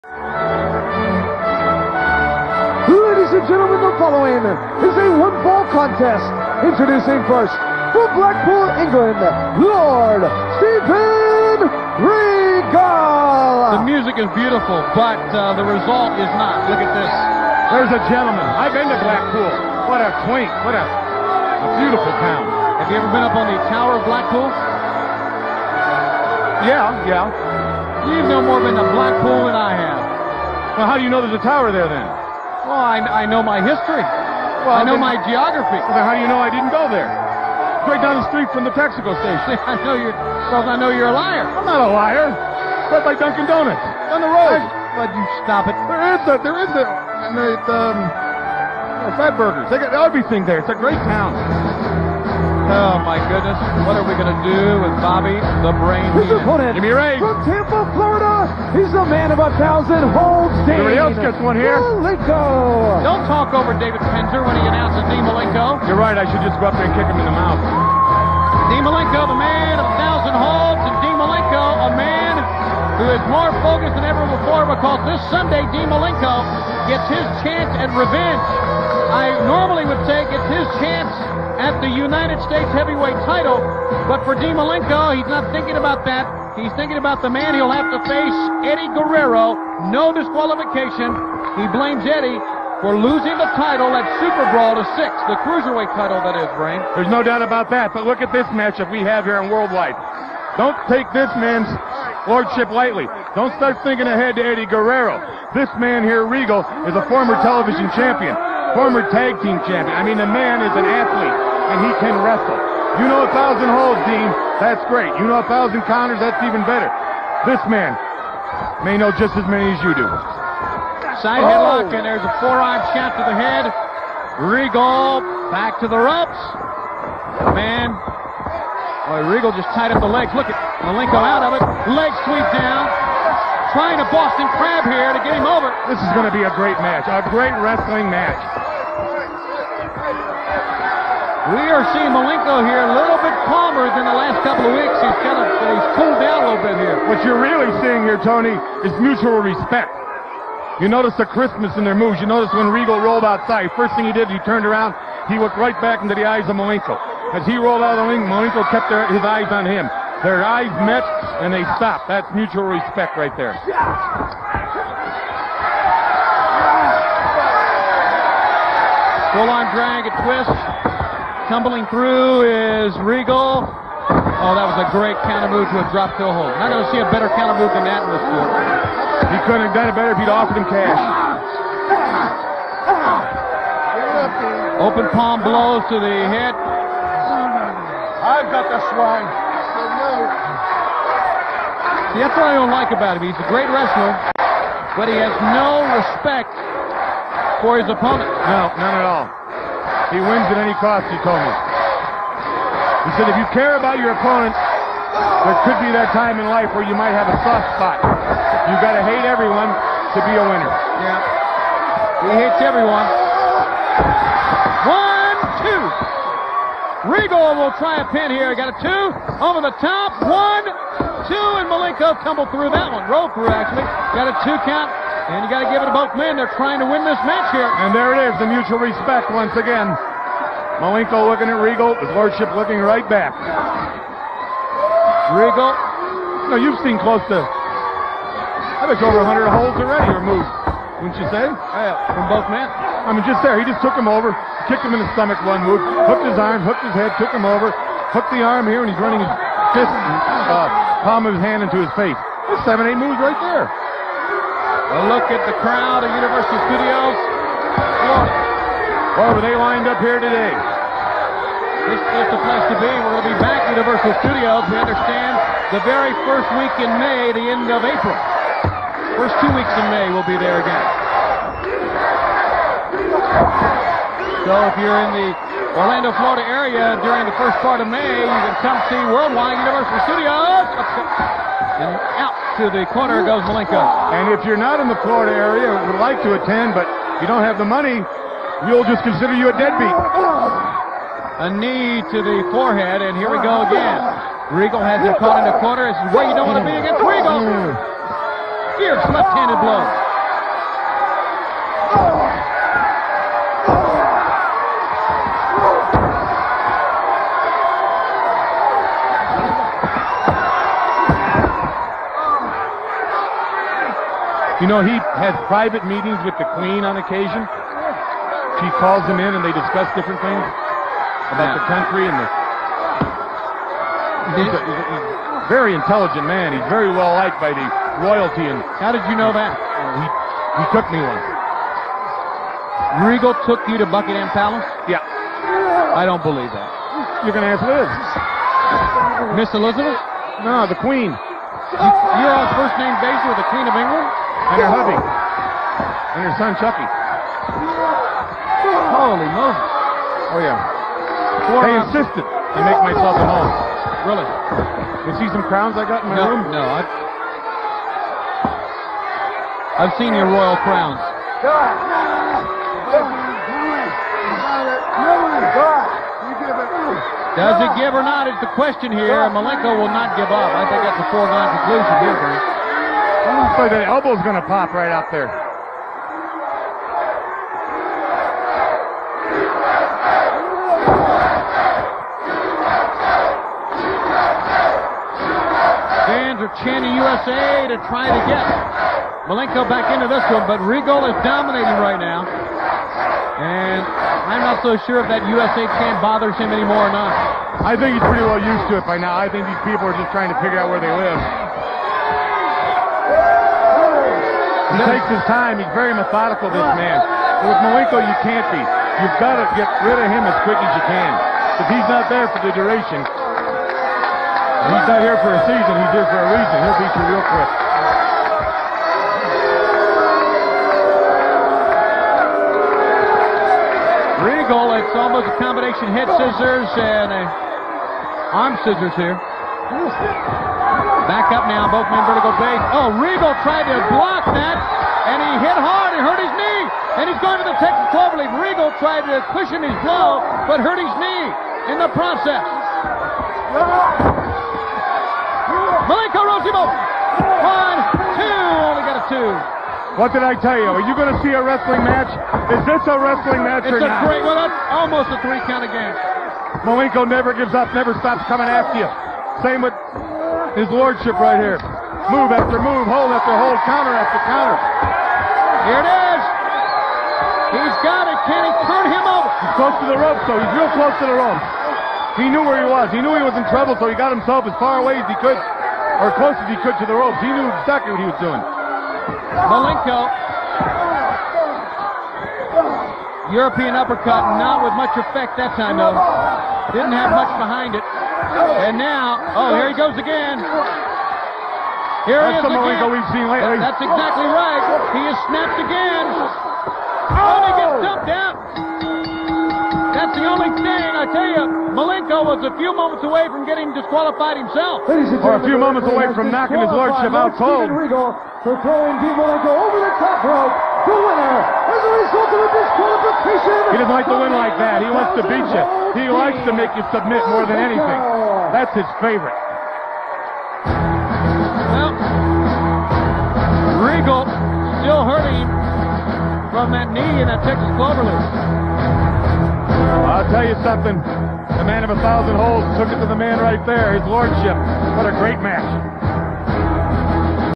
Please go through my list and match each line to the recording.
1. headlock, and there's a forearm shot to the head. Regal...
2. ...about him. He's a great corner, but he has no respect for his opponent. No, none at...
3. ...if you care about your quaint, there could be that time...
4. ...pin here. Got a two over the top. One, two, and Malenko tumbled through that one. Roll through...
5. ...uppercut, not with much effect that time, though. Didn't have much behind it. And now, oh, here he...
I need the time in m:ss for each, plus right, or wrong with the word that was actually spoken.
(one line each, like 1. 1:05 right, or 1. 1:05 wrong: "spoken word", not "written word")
1. 2:01 right
2. 3:12 wrong: "wrestler", not "corner"
3. 3:23 wrong: "opponent", not "quaint"
4. 3:38 right
5. 8:03 right.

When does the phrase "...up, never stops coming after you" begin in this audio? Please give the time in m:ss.
7:37.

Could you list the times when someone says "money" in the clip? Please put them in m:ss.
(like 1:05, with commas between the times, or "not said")
4:47.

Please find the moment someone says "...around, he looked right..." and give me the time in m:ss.
2:34.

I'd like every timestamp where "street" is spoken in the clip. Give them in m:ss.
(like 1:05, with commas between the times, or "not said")
0:38.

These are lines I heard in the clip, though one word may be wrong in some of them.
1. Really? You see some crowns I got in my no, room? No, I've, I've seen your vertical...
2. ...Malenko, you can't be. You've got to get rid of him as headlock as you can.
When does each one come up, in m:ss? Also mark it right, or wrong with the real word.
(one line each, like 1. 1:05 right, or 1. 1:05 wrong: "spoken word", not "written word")
1. 5:54 wrong: "royal", not "vertical"
2. 6:47 wrong: "quick", not "headlock".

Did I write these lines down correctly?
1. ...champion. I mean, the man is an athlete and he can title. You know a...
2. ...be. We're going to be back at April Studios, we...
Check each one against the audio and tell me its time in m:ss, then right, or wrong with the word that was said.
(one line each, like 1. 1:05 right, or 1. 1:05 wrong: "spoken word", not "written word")
1. 1:49 wrong: "wrestle", not "title"
2. 4:22 wrong: "Universal", not "April".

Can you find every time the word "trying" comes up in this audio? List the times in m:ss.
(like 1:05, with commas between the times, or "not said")
2:13, 3:46.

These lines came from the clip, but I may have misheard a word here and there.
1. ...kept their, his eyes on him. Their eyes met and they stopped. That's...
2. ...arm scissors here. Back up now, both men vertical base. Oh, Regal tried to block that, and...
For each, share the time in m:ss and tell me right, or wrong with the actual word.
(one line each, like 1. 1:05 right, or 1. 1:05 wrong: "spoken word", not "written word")
1. 2:38 right
2. 7:08 right.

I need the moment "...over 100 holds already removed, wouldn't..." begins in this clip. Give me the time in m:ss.
3:58.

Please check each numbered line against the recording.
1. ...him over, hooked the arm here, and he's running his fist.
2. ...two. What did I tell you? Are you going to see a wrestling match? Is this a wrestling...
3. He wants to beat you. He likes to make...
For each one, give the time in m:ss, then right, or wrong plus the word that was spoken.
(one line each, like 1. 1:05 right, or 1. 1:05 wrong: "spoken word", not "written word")
1. 4:07 right
2. 7:29 right
3. 8:34 right.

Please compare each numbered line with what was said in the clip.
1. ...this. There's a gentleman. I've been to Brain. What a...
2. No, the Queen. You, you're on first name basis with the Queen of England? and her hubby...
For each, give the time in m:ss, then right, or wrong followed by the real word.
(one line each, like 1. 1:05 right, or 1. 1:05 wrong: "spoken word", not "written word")
1. 0:16 wrong: "Blackpool", not "Brain"
2. 5:40 right.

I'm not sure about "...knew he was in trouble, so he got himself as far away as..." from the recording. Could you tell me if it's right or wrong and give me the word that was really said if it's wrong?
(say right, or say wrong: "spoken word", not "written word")
right.